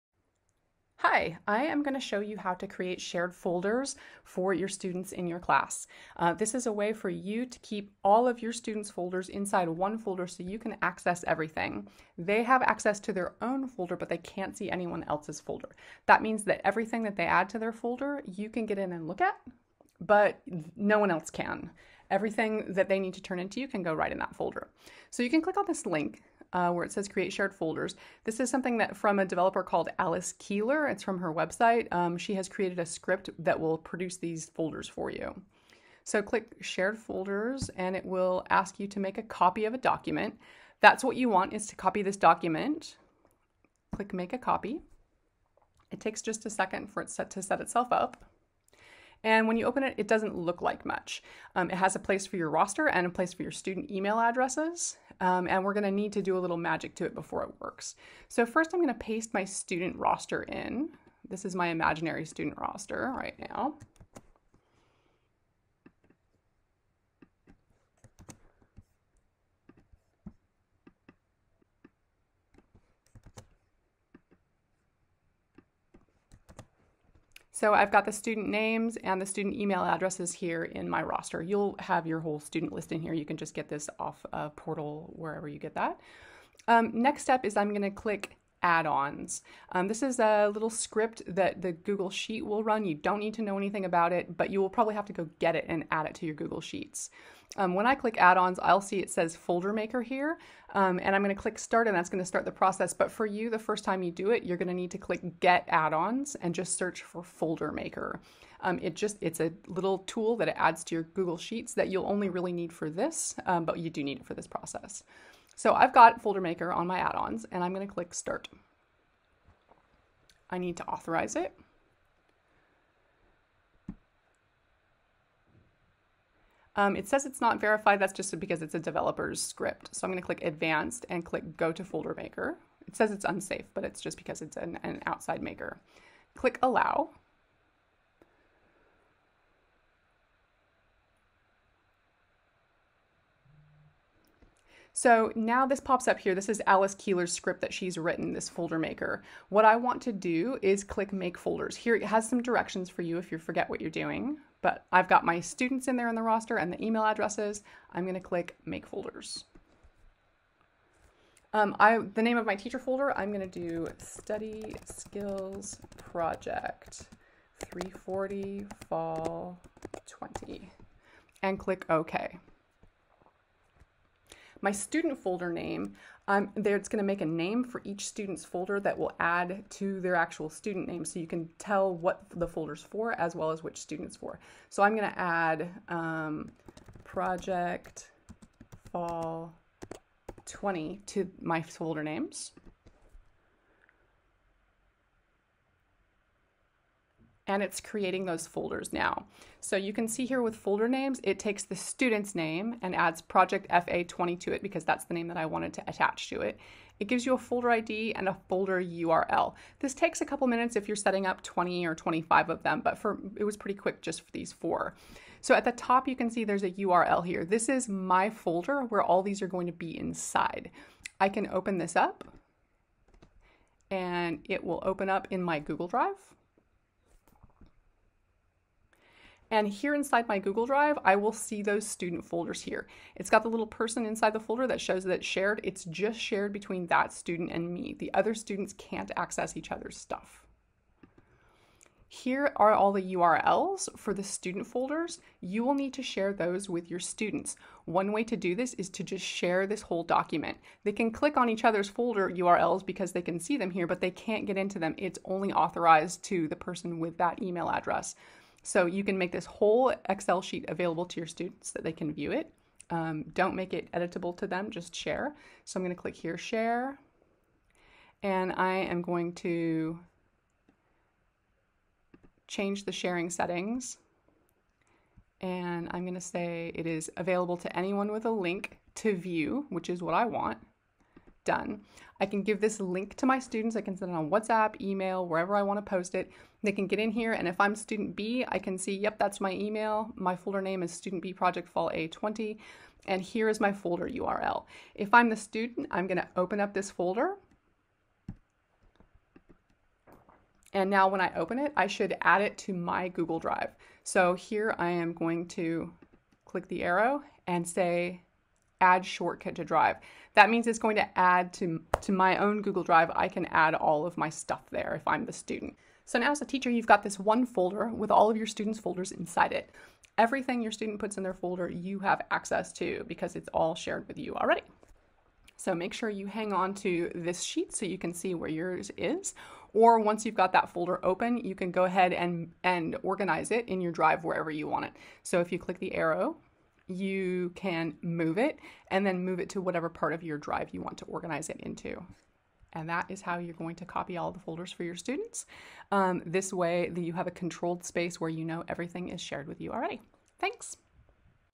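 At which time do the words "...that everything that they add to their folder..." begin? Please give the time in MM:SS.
00:16.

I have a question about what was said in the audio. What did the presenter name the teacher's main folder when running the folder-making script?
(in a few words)
study skills project 340 fall 20.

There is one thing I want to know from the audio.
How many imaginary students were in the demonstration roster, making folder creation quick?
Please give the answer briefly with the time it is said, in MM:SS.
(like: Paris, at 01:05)
4, at 03:34.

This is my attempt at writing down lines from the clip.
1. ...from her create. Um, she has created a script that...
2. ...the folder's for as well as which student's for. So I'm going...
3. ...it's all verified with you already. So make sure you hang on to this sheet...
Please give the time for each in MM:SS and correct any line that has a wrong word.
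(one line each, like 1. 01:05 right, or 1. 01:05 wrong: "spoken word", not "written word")
1. 00:31 wrong: "website", not "create"
2. 03:02 right
3. 05:23 wrong: "shared", not "verified".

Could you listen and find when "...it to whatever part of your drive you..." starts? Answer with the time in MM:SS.
05:39.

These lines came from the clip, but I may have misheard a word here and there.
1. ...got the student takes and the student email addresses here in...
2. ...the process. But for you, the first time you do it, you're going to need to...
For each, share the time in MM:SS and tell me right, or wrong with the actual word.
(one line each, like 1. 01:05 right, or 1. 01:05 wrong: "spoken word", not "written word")
1. 01:17 wrong: "names", not "takes"
2. 01:42 right.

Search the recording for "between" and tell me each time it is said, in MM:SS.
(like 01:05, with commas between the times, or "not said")
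03:56.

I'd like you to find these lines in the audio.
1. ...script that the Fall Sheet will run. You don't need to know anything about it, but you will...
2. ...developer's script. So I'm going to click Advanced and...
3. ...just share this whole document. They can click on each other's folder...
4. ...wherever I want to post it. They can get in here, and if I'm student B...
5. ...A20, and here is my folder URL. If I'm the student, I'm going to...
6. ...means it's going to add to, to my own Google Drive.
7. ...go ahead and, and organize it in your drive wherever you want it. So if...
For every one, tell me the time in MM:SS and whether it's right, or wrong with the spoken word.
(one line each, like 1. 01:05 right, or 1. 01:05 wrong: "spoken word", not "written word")
1. 01:30 wrong: "Google", not "Fall"
2. 02:08 right
3. 04:09 right
4. 04:45 right
5. 04:51 right
6. 05:10 right
7. 05:31 right.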